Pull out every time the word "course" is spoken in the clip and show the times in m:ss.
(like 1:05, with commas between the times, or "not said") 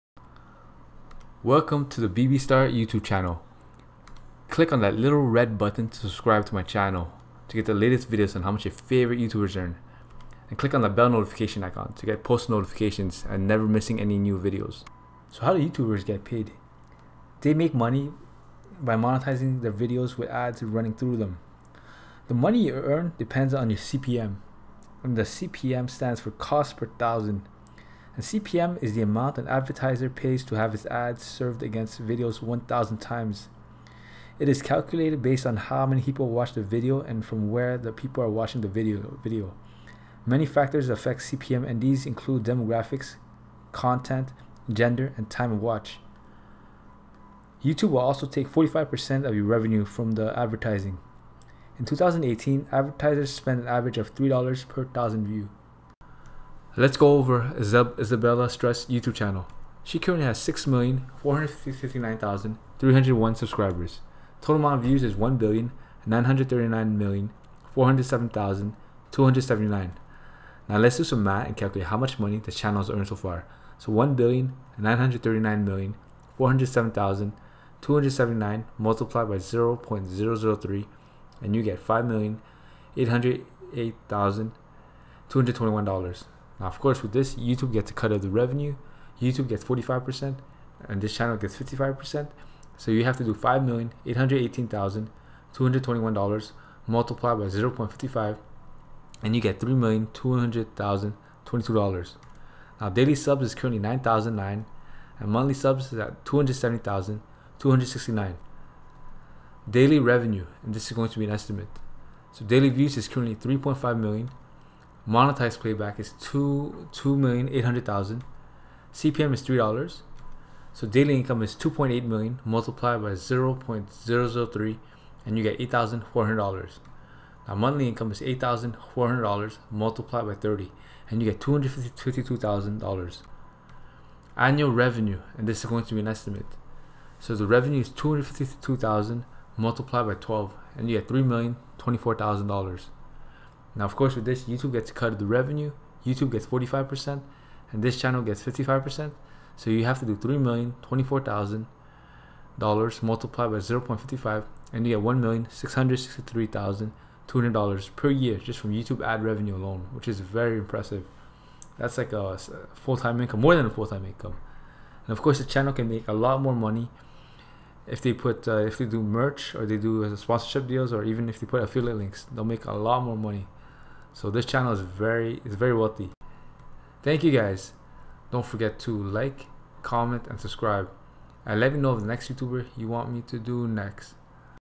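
2:23, 2:45.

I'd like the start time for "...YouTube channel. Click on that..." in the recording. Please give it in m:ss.
0:02.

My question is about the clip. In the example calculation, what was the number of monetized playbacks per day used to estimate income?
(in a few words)
2,800,000.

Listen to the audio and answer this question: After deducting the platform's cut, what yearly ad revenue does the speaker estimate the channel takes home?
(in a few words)
$1,663,200.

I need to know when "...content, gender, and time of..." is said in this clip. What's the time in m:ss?
0:43.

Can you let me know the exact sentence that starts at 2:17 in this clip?
So the revenue is 252,000 multiplied by 12 and you get $3,024,000.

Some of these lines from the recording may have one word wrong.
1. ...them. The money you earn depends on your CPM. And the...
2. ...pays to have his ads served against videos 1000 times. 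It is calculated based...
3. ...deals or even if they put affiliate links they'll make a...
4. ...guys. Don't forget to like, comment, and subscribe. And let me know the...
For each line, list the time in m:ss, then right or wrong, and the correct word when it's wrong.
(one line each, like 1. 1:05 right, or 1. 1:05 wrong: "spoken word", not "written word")
1. 0:21 right
2. 0:30 right
3. 2:50 right
4. 2:57 right.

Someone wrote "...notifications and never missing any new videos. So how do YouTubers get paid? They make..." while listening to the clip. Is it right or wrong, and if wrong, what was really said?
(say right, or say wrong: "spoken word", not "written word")
right.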